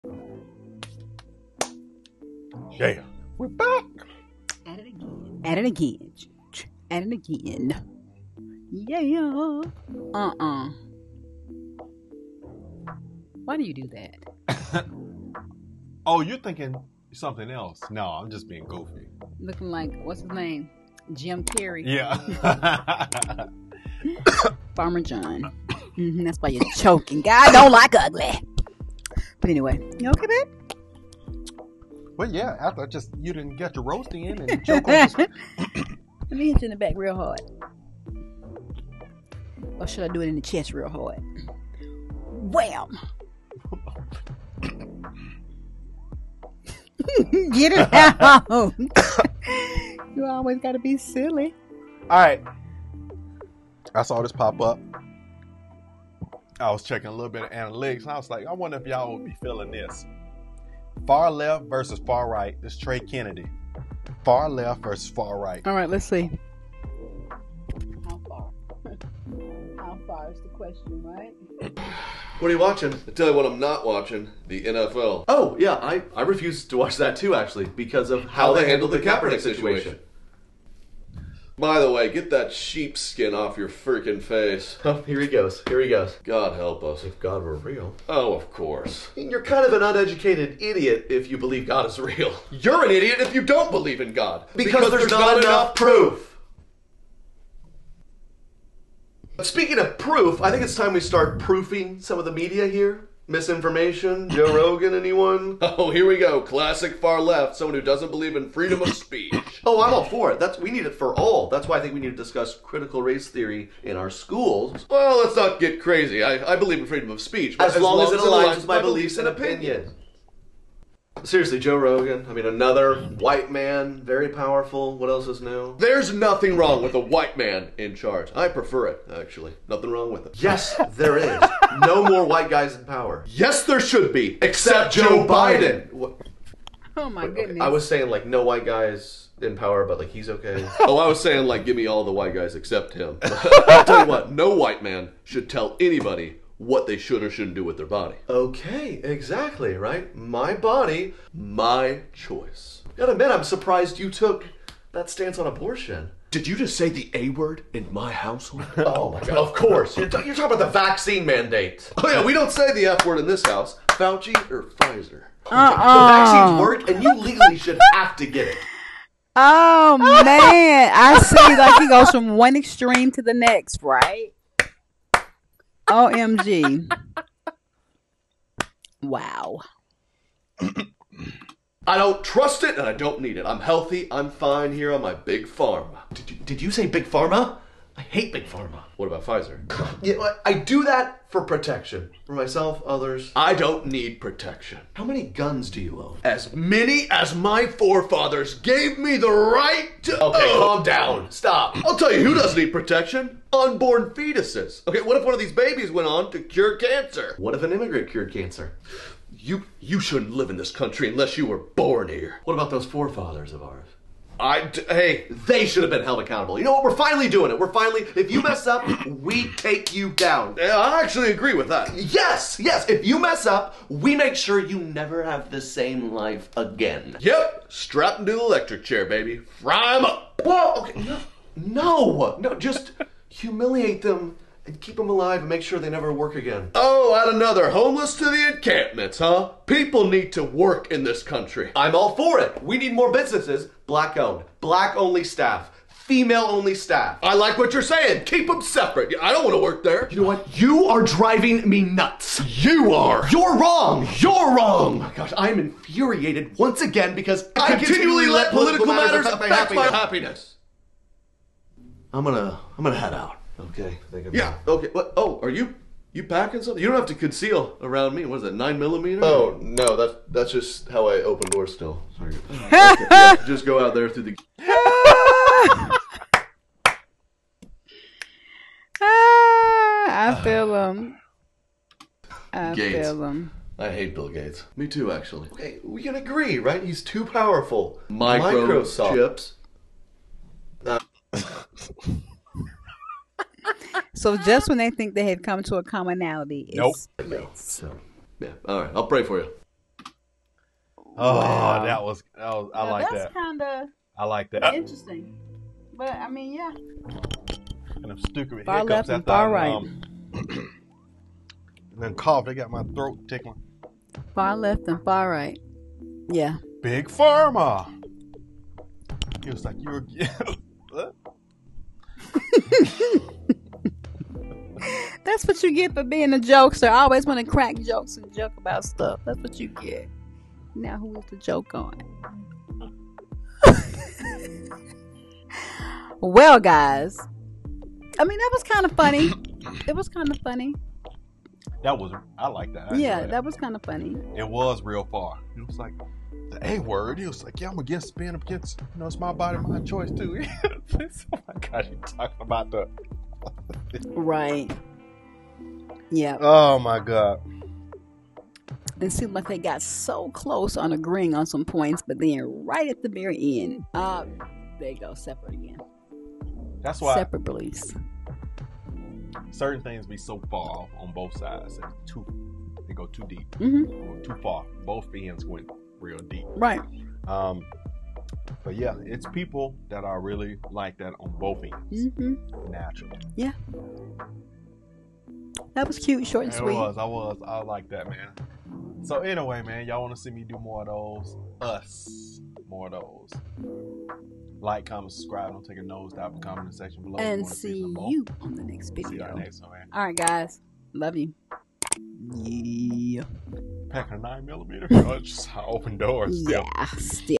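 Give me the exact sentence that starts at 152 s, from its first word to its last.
Gotta admit, I'm surprised you took that stance on abortion.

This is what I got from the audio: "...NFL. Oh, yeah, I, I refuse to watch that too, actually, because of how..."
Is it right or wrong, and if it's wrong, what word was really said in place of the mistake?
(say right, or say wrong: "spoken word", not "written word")
right.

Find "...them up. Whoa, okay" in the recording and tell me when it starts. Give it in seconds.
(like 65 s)
229 s.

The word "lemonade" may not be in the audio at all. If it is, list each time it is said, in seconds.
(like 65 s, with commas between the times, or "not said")
not said.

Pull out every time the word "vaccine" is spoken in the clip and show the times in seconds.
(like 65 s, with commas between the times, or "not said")
160 s, 166 s.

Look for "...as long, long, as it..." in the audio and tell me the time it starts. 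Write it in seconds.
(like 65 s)
117 s.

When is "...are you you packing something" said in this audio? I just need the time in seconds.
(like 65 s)
265 s.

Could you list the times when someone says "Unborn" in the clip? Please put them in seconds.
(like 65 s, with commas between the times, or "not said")
203 s.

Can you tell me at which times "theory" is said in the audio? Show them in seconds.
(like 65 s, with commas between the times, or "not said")
113 s.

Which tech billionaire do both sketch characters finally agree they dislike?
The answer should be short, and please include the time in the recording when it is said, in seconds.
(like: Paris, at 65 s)
Bill Gates, at 284 s.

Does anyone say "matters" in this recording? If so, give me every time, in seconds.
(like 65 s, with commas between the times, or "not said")
259 s.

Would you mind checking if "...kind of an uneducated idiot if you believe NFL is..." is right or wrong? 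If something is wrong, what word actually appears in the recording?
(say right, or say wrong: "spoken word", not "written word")
wrong: "God", not "NFL".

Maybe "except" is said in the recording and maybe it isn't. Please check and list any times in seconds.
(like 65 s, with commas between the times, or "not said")
134 s, 142 s.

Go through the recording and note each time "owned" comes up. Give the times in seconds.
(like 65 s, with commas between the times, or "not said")
244 s.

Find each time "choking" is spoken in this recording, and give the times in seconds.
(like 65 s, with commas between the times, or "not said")
26 s.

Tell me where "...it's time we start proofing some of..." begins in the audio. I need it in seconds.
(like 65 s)
100 s.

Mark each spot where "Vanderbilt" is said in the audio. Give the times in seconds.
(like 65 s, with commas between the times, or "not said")
not said.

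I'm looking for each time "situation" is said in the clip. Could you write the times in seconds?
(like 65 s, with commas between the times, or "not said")
79 s.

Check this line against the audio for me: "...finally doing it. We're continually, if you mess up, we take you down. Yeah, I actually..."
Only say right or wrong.
wrong.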